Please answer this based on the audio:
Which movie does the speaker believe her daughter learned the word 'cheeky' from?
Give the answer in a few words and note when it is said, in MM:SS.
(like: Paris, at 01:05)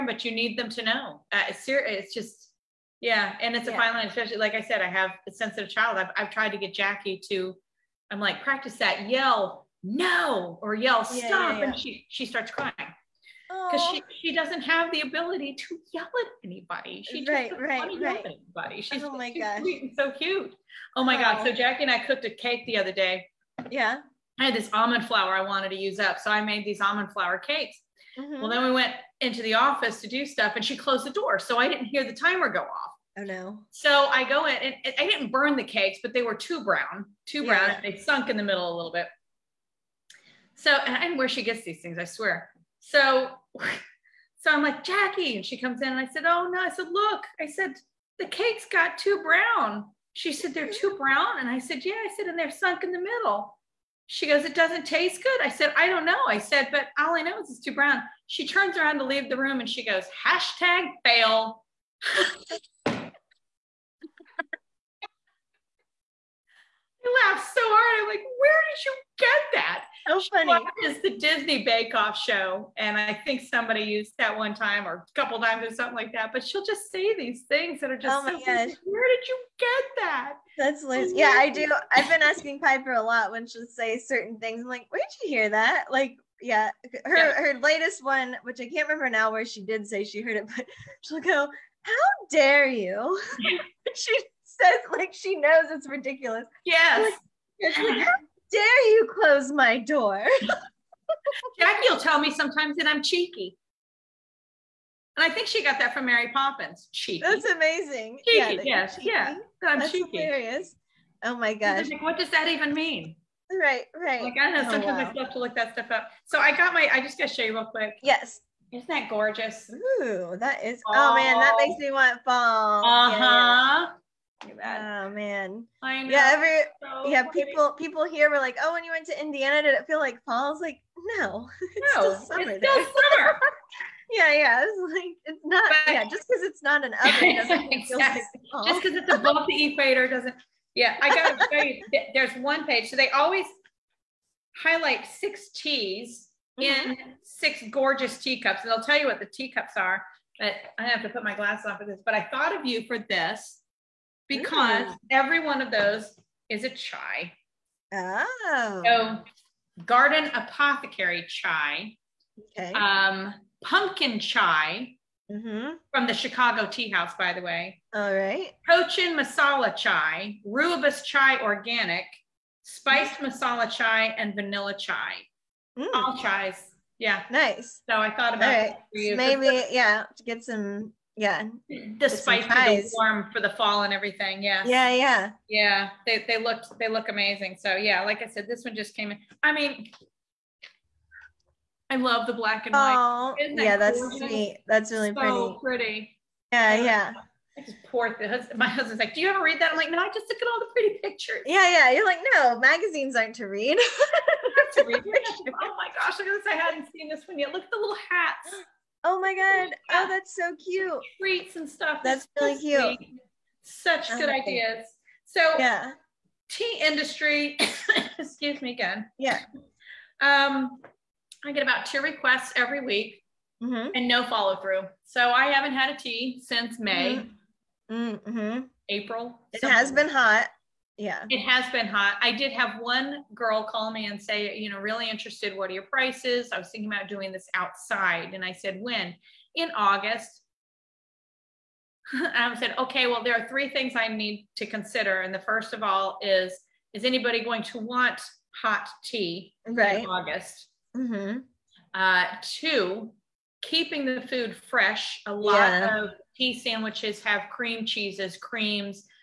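Mary Poppins, at 01:46.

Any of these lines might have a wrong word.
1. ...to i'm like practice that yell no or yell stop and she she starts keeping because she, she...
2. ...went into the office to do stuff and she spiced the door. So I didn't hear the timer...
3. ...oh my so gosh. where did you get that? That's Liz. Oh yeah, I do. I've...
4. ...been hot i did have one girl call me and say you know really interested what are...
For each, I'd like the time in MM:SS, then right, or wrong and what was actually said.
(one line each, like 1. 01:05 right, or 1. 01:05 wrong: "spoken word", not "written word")
1. 00:07 wrong: "crying", not "keeping"
2. 00:28 wrong: "closed", not "spiced"
3. 01:18 right
4. 03:51 right.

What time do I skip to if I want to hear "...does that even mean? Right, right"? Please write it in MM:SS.
01:52.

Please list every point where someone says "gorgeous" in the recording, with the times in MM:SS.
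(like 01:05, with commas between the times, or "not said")
01:59, 02:27, 03:14.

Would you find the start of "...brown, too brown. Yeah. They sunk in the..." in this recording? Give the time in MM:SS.
00:36.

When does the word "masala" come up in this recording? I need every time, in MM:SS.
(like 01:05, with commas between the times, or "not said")
02:49, 02:53.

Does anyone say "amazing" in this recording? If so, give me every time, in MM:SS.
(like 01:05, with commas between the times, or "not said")
01:47, 03:07.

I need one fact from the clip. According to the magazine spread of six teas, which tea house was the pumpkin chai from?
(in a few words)
Chicago Tea House.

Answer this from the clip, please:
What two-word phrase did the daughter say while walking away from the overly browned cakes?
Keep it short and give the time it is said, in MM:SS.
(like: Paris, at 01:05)
Hashtag fail, at 01:00.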